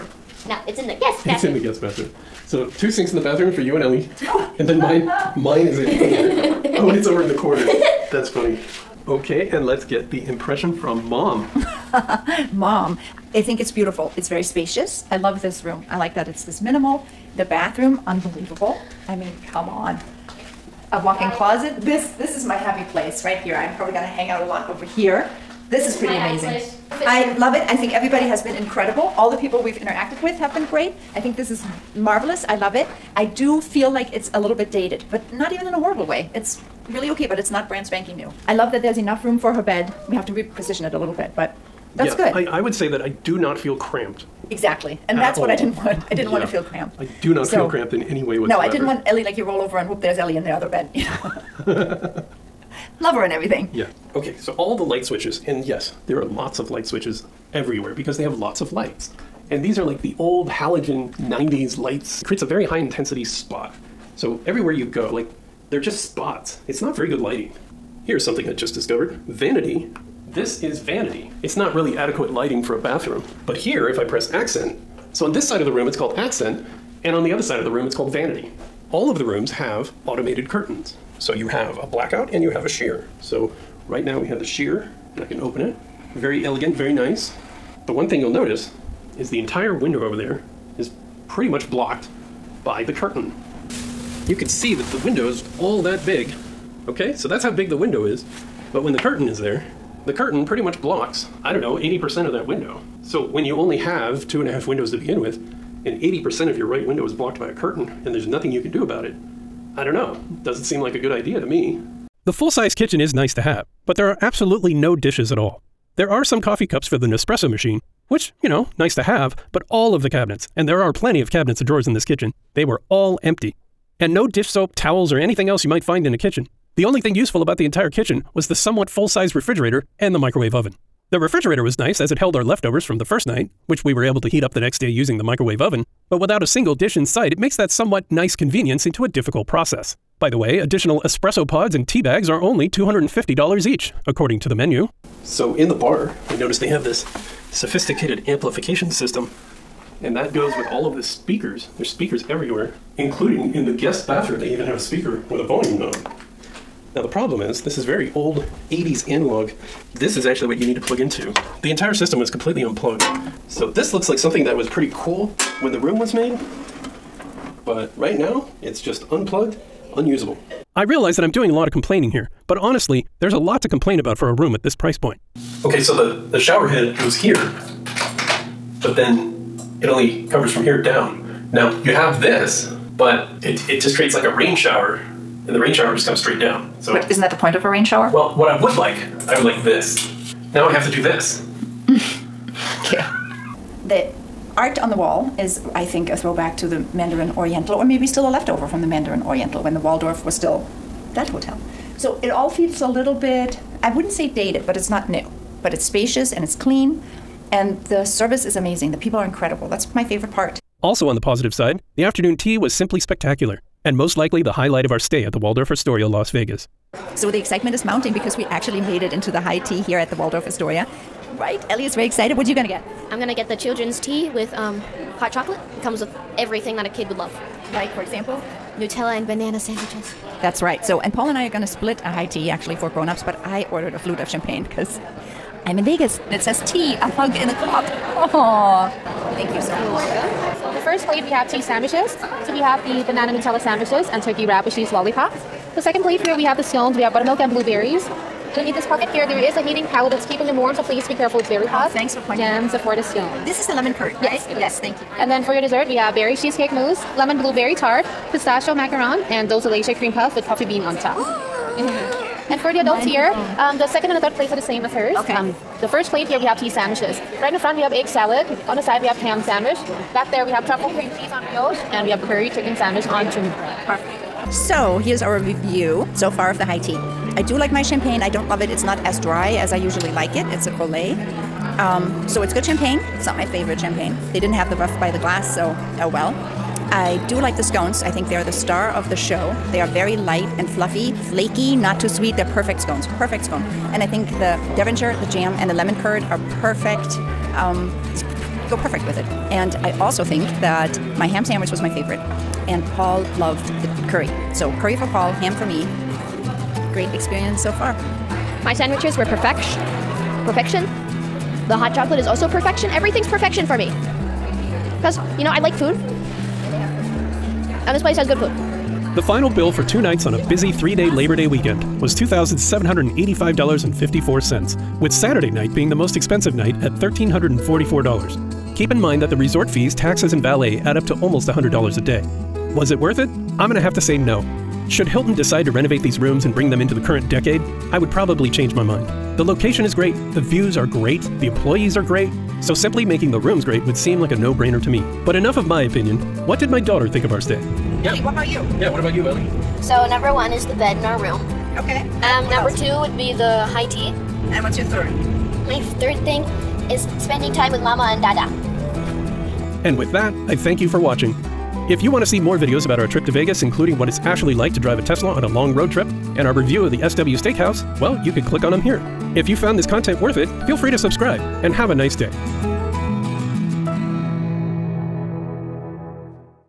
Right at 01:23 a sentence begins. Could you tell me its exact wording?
So right now we have the sheer and I can open it.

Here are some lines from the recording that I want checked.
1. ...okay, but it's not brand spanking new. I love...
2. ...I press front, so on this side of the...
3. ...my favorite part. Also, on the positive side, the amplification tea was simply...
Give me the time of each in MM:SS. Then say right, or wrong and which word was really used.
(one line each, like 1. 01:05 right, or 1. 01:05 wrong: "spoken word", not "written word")
1. 00:37 right
2. 01:13 wrong: "accent", not "front"
3. 03:29 wrong: "afternoon", not "amplification".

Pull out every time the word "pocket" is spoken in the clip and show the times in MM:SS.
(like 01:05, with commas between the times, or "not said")
04:08.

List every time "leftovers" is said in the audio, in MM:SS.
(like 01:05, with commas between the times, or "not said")
02:12, 03:18.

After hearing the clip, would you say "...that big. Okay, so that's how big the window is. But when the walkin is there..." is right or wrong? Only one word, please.
wrong.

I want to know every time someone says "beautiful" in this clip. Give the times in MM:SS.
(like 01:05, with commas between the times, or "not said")
00:13.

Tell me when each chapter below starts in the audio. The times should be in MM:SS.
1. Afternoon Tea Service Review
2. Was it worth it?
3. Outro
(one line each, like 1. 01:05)
1. 03:29
2. 05:31
3. 05:59.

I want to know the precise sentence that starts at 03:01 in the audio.
Now you have this, but it, it just creates like a rain shower, and the rain shower just comes straight down.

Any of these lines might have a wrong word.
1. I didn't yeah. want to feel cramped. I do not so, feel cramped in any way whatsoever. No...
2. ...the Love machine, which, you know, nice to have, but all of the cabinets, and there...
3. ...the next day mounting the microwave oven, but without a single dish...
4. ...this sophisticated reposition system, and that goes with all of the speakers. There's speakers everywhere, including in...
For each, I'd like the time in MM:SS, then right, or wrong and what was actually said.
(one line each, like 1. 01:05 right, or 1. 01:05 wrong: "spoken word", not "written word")
1. 00:46 right
2. 01:56 wrong: "Nespresso", not "Love"
3. 02:14 wrong: "using", not "mounting"
4. 02:26 wrong: "amplification", not "reposition".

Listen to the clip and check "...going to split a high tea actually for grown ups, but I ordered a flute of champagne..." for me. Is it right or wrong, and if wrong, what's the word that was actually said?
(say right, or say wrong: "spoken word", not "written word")
right.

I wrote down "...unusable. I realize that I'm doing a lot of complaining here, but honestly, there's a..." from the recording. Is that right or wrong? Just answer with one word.
right.